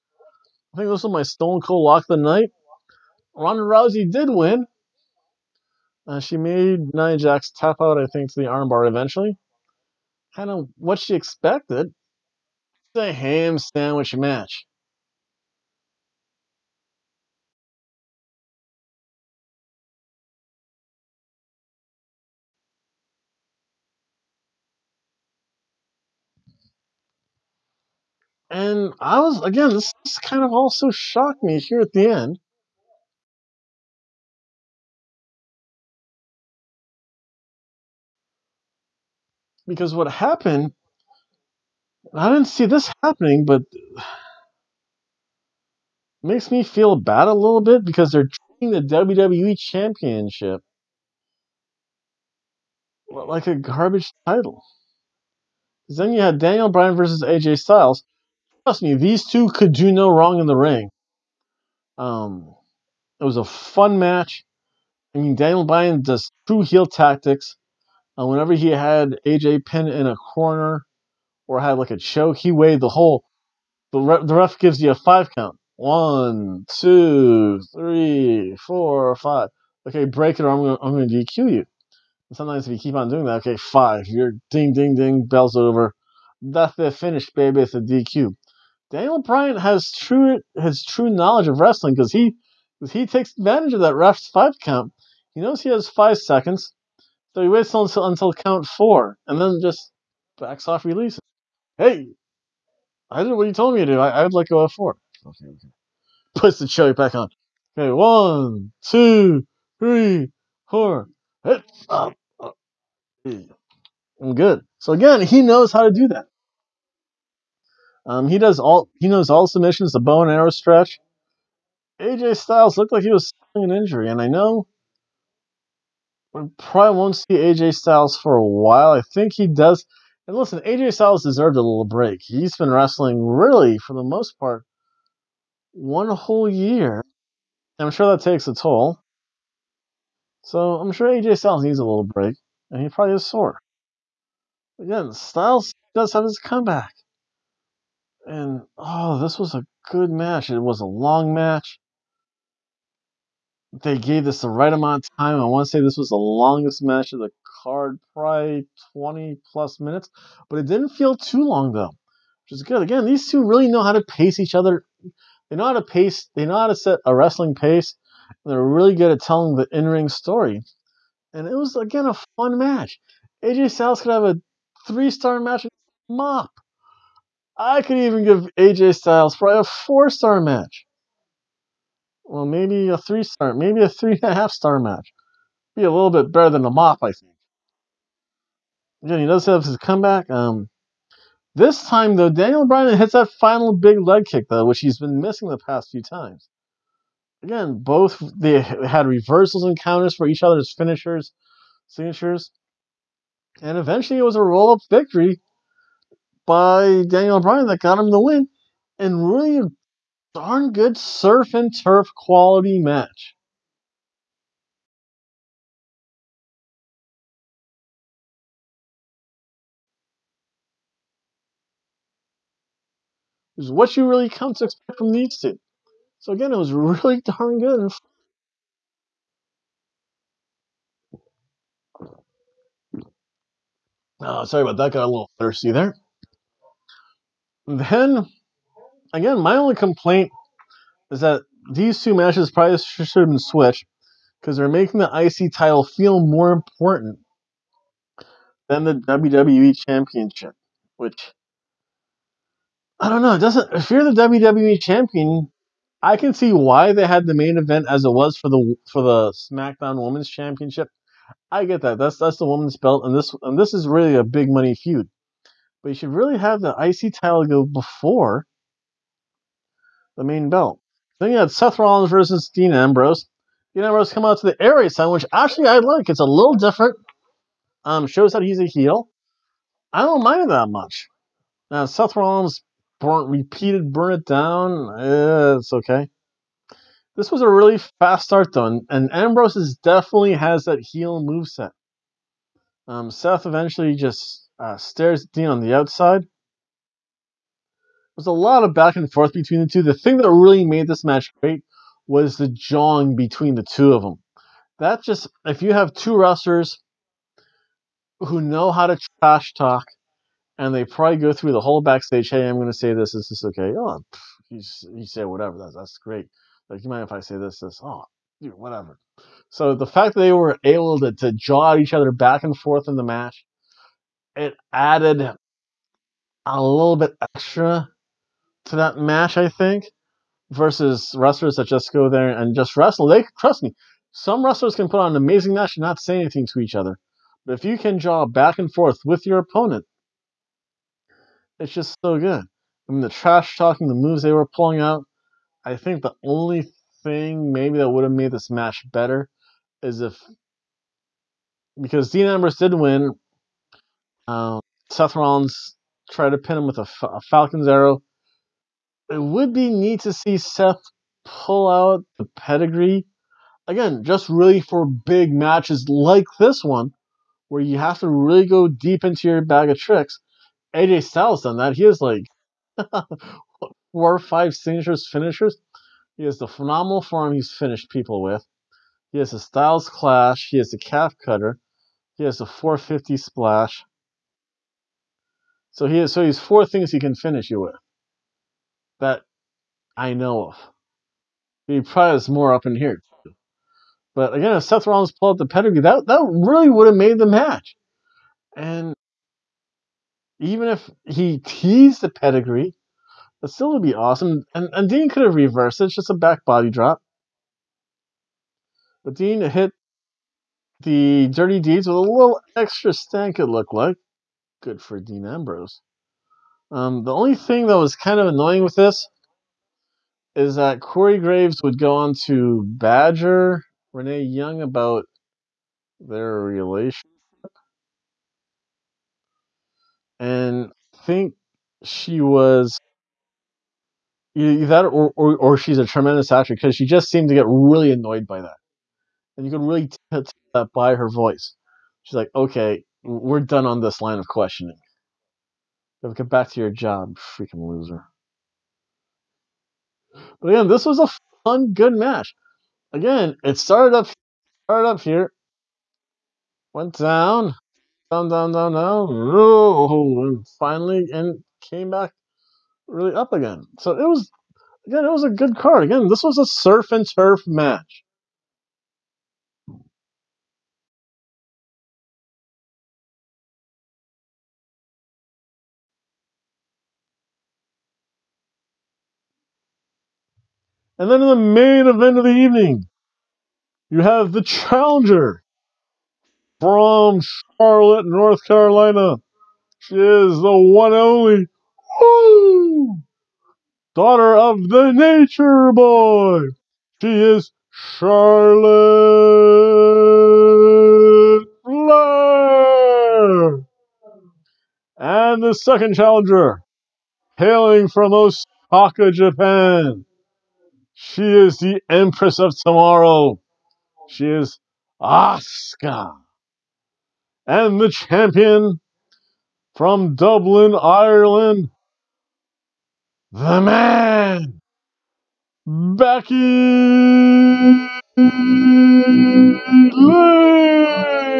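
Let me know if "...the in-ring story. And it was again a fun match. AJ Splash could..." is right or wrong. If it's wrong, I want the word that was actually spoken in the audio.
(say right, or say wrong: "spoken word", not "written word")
wrong: "Styles", not "Splash".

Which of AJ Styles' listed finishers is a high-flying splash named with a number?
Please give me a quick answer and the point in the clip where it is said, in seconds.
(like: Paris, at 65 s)
450 Splash, at 382 s.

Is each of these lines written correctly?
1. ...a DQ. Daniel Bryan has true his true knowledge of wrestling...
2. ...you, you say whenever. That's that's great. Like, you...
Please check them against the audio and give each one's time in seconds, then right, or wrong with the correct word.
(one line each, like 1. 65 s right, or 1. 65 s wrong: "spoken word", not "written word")
1. 87 s right
2. 314 s wrong: "whatever", not "whenever".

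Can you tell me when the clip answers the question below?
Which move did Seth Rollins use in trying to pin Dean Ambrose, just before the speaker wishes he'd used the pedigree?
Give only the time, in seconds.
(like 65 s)
357 s.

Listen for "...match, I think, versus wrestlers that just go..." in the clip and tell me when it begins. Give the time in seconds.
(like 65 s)
328 s.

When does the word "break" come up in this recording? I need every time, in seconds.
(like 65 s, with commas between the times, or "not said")
80 s, 131 s, 142 s.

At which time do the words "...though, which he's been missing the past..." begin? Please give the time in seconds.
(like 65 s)
194 s.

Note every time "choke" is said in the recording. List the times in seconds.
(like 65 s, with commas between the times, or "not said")
71 s, 106 s.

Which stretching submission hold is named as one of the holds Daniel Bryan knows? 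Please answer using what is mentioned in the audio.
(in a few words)
bow and arrow stretch.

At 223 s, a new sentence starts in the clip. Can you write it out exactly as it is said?
Is what you really come to expect from these two.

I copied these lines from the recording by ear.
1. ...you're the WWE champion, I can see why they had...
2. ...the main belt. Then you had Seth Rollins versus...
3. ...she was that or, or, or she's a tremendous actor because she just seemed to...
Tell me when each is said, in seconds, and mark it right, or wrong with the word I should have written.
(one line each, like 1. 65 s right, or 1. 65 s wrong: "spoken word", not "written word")
1. 253 s right
2. 270 s right
3. 431 s right.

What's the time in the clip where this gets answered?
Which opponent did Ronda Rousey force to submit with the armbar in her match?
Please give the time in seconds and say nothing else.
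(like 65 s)
6 s.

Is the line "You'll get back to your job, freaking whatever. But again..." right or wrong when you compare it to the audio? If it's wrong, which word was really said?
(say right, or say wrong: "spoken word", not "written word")
wrong: "loser", not "whatever".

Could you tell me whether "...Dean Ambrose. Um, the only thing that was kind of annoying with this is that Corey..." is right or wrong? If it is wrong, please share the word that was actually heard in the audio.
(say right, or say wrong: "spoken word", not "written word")
right.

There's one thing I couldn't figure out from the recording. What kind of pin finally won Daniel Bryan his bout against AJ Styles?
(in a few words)
roll up.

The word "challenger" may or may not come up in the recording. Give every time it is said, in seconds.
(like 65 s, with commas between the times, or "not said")
484 s, 505 s.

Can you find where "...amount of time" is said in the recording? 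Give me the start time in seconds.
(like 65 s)
154 s.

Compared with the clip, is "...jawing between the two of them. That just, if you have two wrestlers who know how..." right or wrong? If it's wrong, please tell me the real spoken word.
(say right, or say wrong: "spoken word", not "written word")
right.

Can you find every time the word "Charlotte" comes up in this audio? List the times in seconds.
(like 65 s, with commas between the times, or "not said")
487 s, 497 s.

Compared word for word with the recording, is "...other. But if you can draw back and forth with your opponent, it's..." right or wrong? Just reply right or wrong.
right.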